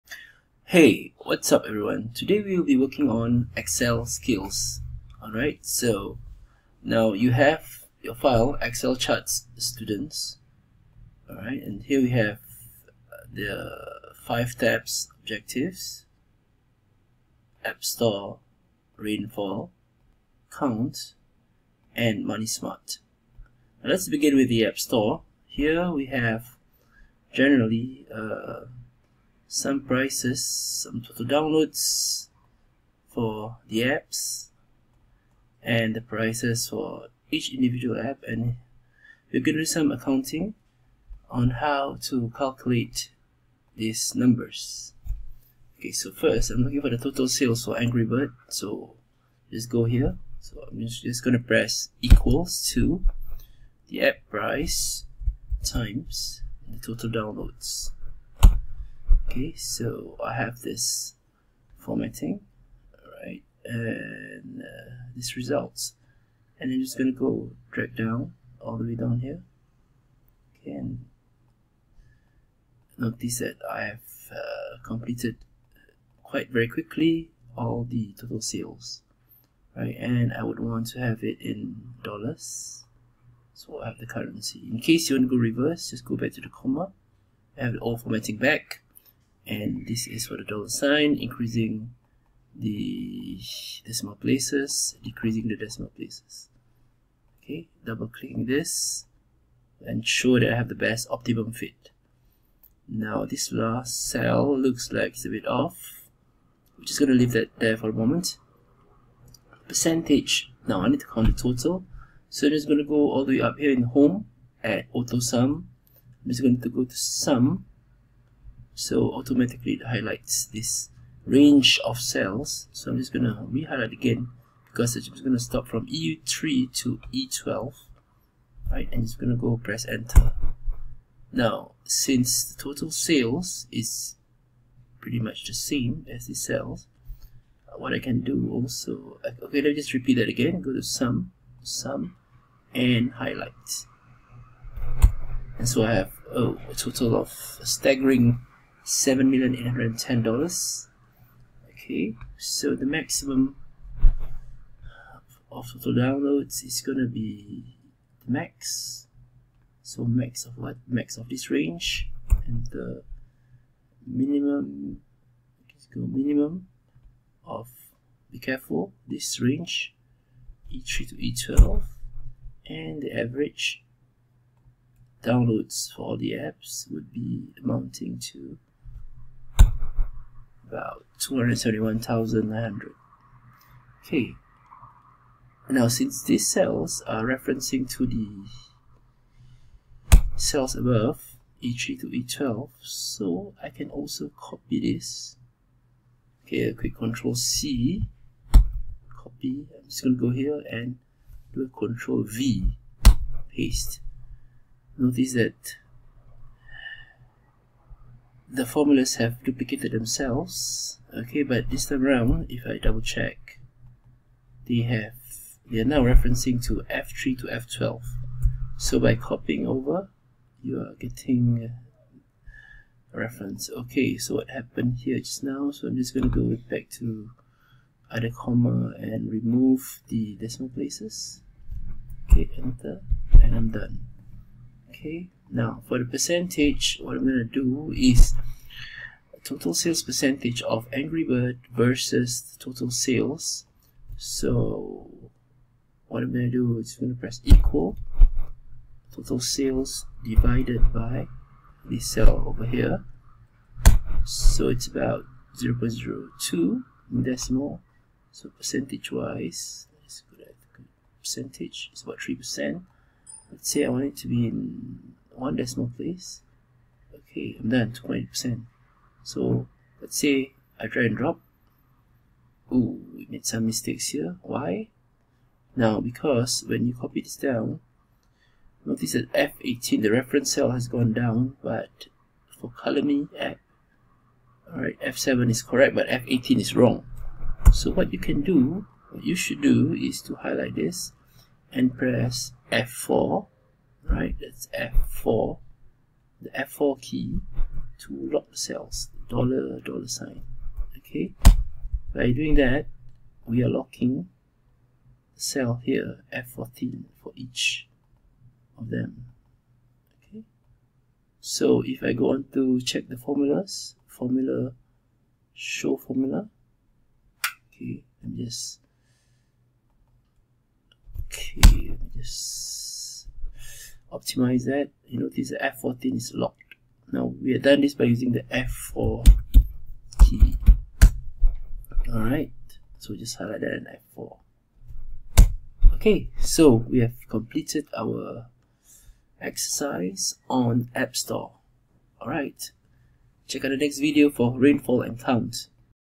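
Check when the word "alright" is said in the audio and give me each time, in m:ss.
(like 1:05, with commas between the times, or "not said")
0:05, 0:11, 4:44, 5:32, 5:42.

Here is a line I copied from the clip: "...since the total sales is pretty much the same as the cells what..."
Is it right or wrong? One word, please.
right.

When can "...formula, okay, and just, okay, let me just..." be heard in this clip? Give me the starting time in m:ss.
5:15.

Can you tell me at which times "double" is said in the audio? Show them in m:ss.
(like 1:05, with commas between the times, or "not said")
1:37, 3:32.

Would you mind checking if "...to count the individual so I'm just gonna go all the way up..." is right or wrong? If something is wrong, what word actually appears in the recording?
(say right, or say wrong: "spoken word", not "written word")
wrong: "total", not "individual".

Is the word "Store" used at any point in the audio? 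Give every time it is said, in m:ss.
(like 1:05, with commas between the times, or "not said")
0:17, 0:24, 5:41.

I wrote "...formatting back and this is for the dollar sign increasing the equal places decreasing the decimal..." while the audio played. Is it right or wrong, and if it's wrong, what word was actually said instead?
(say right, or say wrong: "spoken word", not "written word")
wrong: "decimal", not "equal".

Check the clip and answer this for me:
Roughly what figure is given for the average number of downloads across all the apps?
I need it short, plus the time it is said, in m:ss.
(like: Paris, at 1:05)
271,900, at 3:01.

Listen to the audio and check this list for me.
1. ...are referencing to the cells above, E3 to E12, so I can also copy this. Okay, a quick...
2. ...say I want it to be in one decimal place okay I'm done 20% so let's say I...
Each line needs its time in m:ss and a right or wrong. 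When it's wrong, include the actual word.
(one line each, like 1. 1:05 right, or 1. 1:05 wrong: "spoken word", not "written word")
1. 3:07 right
2. 4:23 right.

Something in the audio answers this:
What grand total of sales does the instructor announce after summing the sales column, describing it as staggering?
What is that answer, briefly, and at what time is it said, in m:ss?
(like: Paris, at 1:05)
$7,000,810, at 2:28.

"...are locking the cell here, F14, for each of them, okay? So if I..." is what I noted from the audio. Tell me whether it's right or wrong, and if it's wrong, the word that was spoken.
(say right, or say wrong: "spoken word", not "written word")
right.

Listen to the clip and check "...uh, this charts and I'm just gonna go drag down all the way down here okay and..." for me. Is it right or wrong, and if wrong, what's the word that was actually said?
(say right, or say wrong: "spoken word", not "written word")
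wrong: "results", not "charts".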